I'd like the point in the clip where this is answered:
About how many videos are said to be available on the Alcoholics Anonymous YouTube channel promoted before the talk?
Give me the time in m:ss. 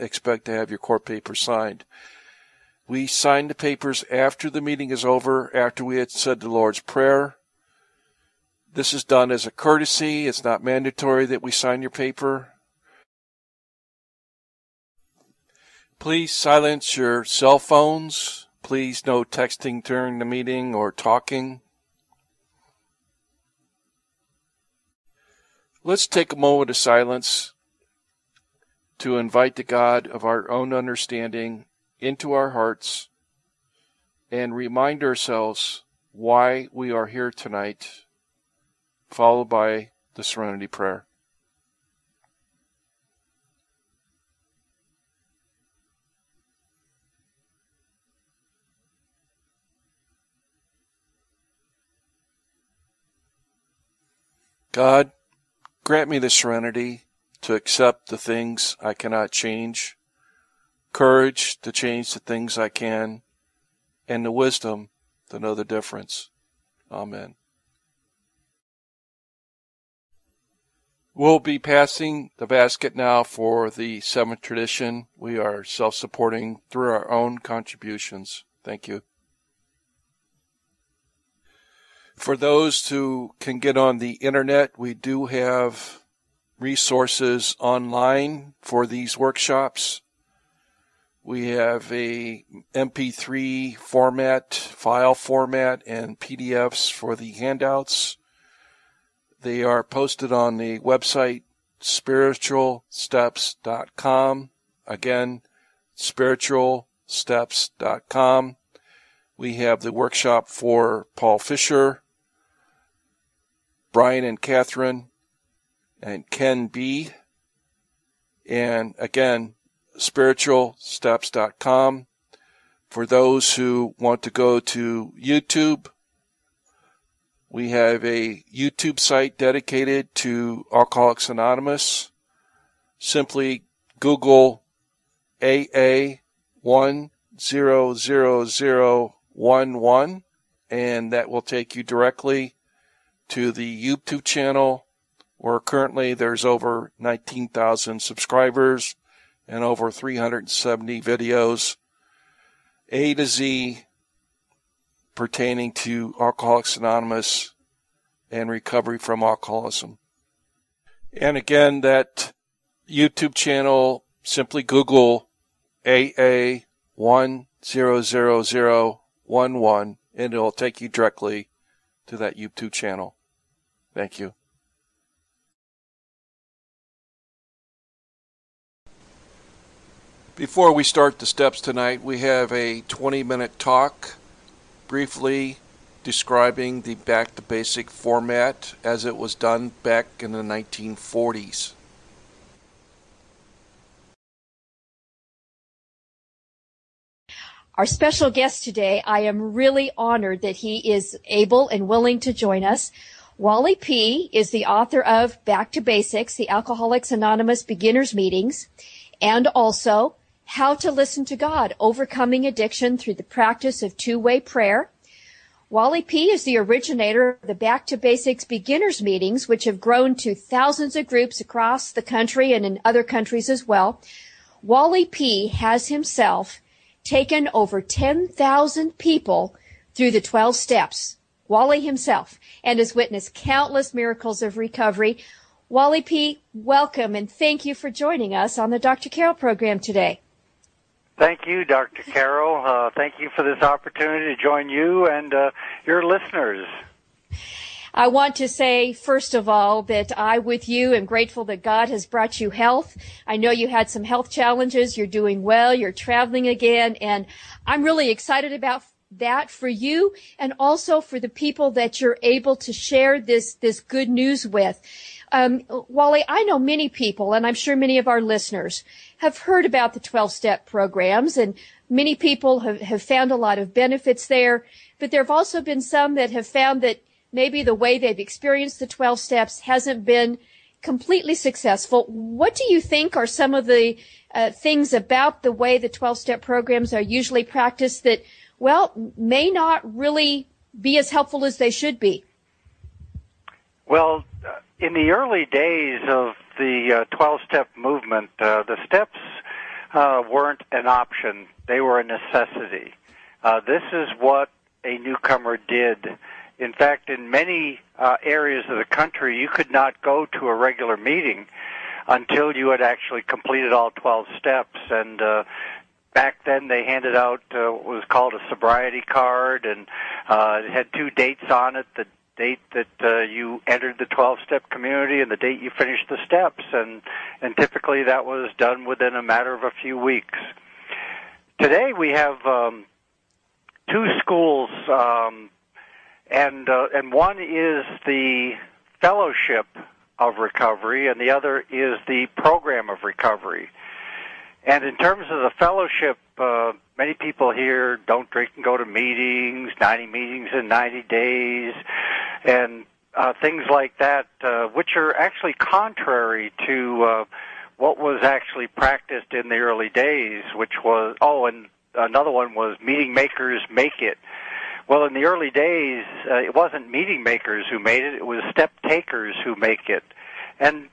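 2:29.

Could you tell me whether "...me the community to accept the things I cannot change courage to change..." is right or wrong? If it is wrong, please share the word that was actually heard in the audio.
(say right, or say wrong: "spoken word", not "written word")
wrong: "serenity", not "community".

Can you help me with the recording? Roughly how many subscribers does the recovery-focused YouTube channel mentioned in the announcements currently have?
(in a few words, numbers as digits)
19,000.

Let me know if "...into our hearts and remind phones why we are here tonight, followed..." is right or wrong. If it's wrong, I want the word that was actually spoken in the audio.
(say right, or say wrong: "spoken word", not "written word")
wrong: "ourselves", not "phones".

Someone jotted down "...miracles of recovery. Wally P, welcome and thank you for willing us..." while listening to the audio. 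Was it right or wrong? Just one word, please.
wrong.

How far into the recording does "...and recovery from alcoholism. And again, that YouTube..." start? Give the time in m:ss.
2:38.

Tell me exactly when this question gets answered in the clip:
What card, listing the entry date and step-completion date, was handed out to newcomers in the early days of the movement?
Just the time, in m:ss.
5:18.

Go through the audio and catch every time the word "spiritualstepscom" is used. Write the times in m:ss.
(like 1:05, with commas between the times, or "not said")
1:41, 1:45, 1:59.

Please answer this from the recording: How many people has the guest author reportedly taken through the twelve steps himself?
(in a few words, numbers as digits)
10,000.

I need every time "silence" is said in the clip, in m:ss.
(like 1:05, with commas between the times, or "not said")
0:16, 0:26.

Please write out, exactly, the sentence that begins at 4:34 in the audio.
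But there have also been some that have found that maybe the way they've experienced the 12 steps hasn't been completely successful.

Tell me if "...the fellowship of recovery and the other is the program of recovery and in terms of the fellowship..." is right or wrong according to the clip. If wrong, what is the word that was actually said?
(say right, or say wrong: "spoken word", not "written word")
right.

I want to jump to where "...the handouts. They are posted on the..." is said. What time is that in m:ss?
1:37.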